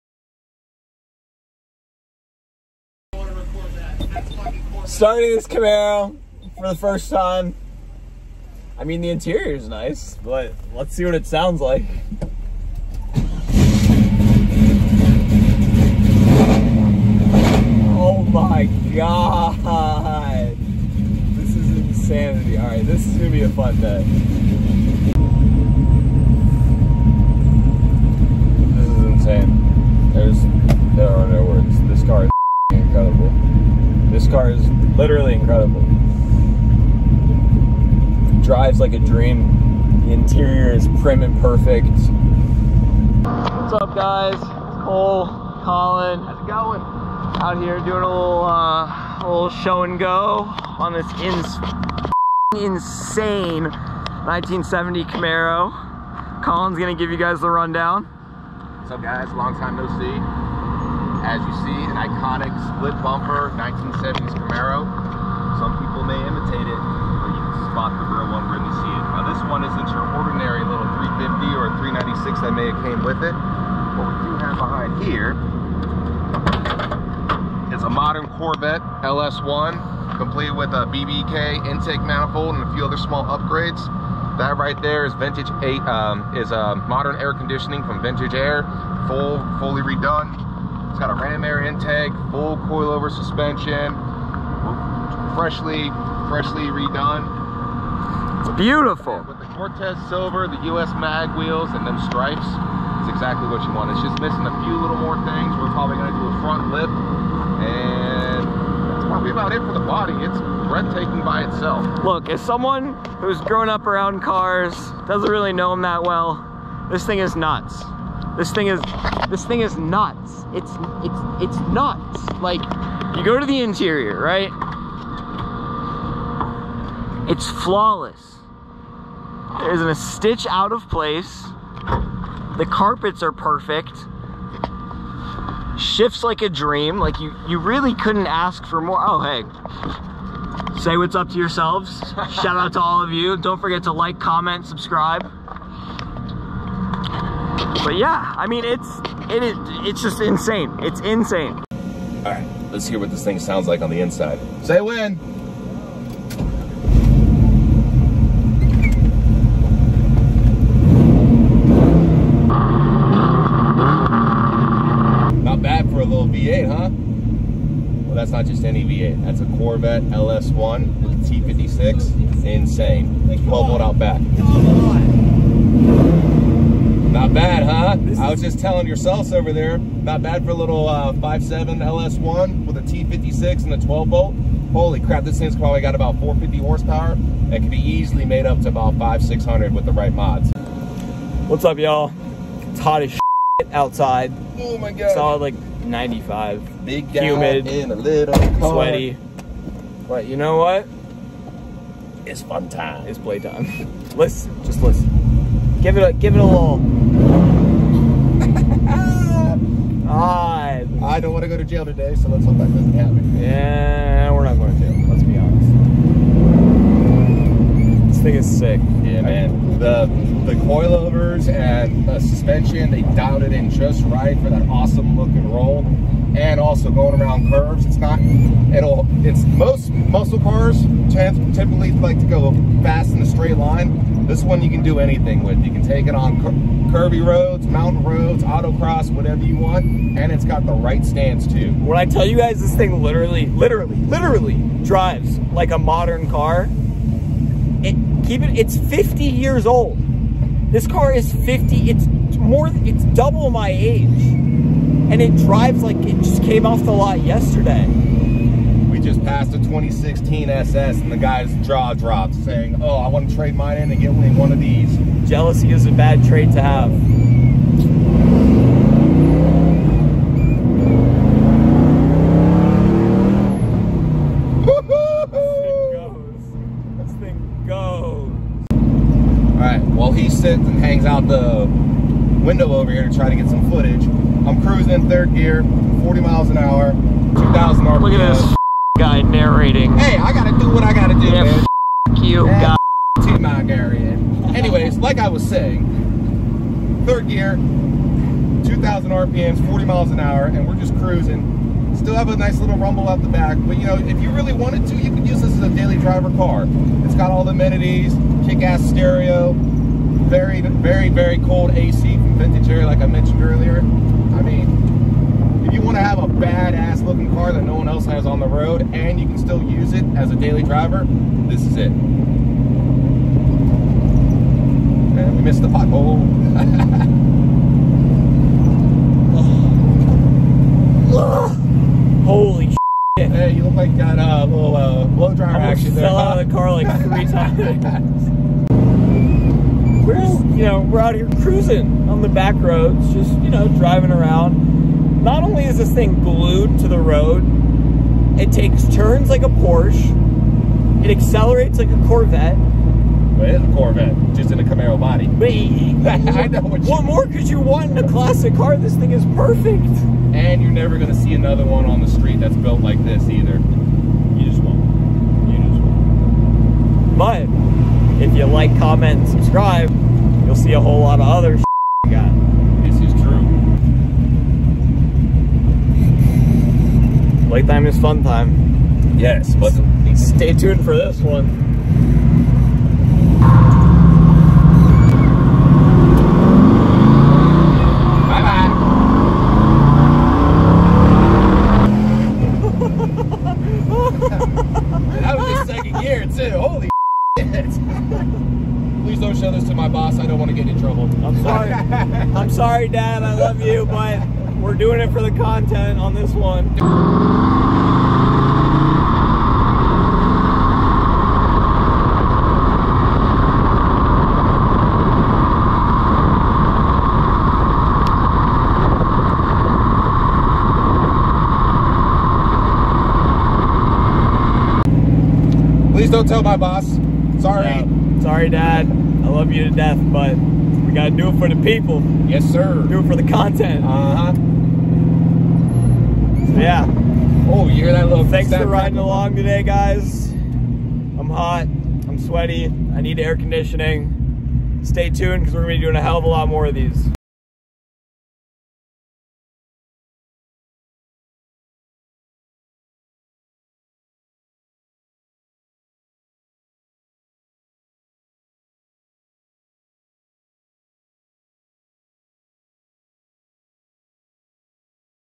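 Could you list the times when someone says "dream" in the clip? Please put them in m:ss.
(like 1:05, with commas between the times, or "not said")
0:38, 2:16.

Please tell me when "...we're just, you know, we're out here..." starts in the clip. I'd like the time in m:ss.
5:40.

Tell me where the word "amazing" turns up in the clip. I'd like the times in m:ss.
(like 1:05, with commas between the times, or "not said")
not said.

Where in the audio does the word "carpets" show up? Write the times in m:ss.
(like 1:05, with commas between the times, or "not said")
2:12.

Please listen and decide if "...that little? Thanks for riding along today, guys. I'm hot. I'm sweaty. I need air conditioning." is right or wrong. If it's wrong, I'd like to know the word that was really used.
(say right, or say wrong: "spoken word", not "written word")
right.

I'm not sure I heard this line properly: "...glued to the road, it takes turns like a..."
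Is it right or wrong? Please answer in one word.
right.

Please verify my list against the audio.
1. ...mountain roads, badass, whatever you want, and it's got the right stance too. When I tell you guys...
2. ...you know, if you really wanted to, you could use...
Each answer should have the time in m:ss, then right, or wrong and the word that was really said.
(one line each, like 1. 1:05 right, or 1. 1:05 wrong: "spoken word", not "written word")
1. 3:57 wrong: "autocross", not "badass"
2. 5:03 right.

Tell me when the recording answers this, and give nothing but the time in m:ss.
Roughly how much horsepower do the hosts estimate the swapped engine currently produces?
3:06.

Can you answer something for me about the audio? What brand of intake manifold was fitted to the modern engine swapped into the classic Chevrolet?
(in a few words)
BBK.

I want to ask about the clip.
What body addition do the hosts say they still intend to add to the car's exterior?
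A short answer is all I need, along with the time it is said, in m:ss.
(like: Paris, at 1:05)
A front lip, at 1:46.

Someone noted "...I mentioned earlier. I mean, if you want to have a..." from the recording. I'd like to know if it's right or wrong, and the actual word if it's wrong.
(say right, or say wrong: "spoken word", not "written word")
right.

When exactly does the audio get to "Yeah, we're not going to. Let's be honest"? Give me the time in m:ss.
3:33.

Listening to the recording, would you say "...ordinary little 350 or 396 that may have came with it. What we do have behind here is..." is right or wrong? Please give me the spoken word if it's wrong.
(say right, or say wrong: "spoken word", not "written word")
right.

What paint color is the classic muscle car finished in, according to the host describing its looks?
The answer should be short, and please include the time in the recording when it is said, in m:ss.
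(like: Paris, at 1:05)
Cortez silver, at 1:39.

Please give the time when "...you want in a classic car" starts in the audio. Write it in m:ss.
5:57.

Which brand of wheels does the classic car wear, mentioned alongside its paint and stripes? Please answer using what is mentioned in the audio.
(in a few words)
US mag.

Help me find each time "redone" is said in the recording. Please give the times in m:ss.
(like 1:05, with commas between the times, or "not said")
1:29, 1:36.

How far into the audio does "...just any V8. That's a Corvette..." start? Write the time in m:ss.
2:48.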